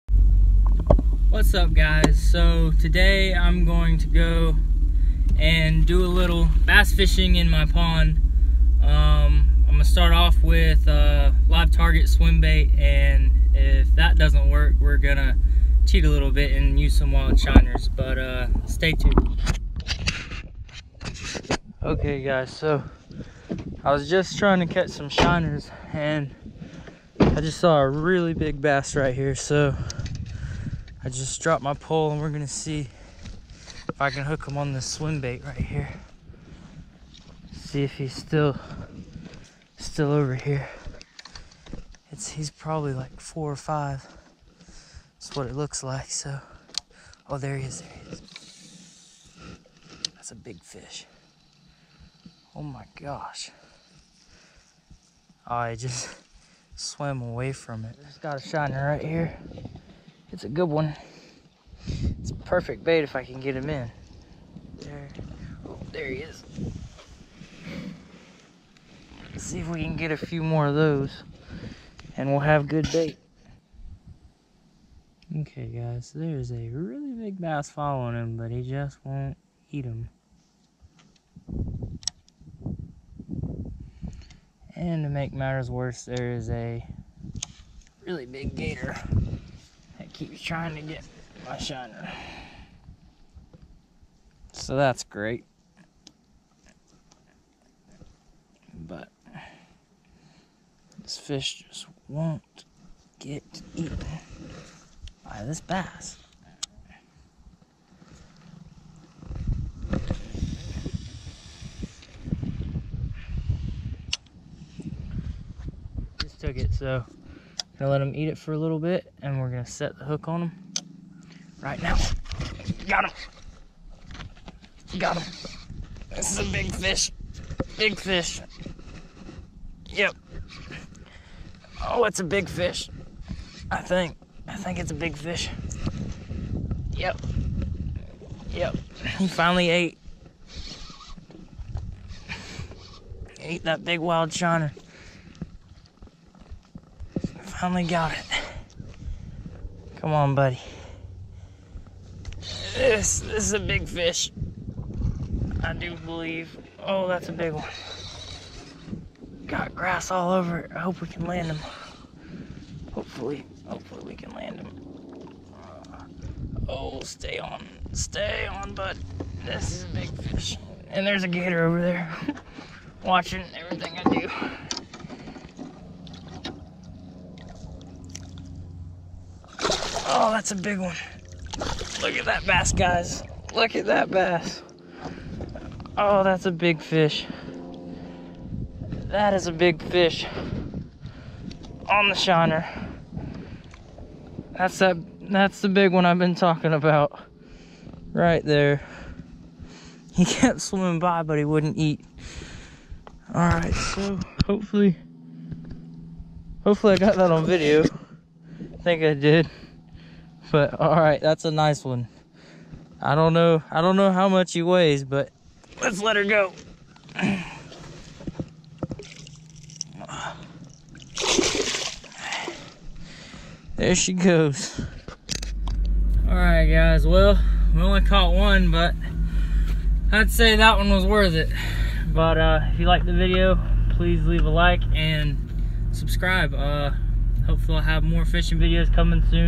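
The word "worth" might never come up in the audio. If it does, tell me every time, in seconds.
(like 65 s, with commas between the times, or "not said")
231 s.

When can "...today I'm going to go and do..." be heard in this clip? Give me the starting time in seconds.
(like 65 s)
2 s.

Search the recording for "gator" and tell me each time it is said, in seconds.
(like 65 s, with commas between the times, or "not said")
88 s, 171 s.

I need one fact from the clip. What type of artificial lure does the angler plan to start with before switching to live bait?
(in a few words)
live target swim bait.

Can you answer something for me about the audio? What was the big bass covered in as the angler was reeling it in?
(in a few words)
grass.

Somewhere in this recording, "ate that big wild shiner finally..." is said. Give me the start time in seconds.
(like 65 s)
143 s.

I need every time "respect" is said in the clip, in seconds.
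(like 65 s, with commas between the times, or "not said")
not said.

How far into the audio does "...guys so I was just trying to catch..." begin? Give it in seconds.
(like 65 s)
22 s.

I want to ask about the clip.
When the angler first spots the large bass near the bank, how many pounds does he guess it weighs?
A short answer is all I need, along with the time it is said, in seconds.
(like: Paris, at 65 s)
4 or 5, at 43 s.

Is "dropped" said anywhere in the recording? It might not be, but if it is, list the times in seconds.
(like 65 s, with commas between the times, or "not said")
31 s.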